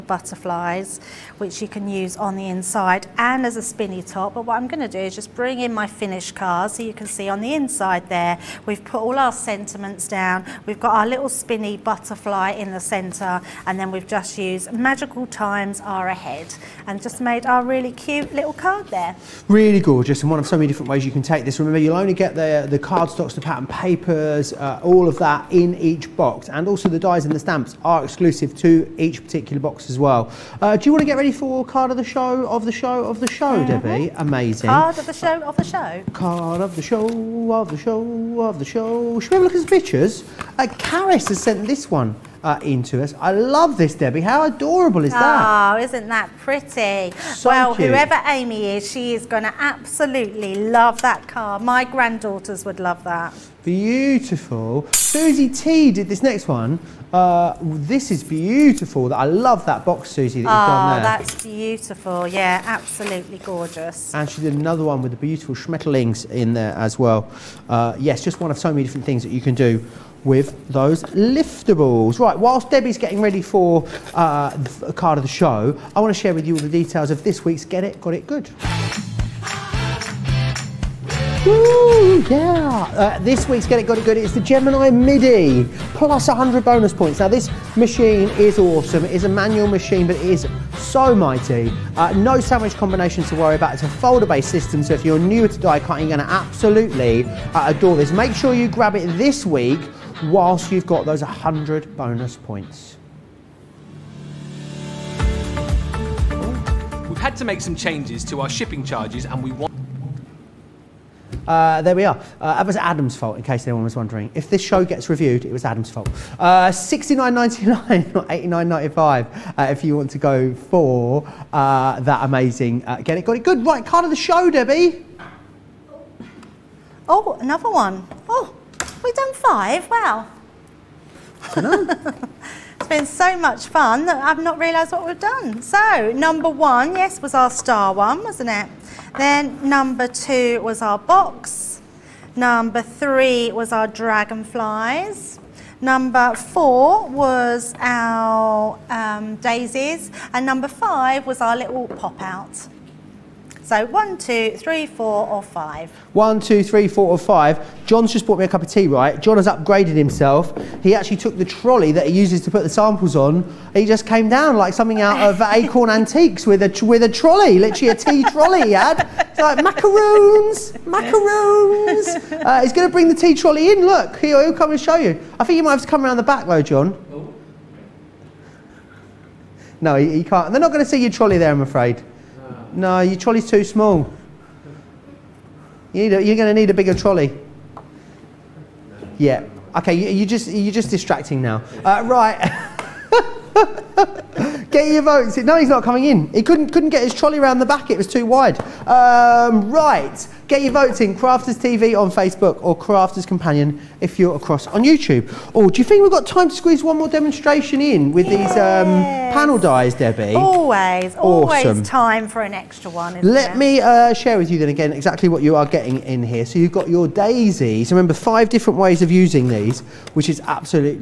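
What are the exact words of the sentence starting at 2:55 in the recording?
I think you might have to come around the back though, John.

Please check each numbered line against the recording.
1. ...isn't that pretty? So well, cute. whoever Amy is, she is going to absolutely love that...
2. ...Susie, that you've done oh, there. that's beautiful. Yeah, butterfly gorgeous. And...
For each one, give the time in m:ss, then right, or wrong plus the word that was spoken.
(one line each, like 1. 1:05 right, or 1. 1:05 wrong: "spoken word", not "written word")
1. 0:45 right
2. 1:00 wrong: "absolutely", not "butterfly".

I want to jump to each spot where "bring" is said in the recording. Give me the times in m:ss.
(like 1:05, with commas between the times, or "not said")
0:05, 2:52.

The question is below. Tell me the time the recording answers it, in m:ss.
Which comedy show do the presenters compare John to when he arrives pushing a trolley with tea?
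2:45.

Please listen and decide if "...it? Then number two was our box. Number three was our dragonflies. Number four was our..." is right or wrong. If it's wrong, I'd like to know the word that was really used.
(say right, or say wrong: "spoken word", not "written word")
right.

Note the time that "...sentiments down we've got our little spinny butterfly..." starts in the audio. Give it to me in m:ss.
0:09.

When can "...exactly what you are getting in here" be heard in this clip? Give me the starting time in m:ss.
3:34.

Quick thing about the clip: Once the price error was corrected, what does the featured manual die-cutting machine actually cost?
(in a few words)
69.99.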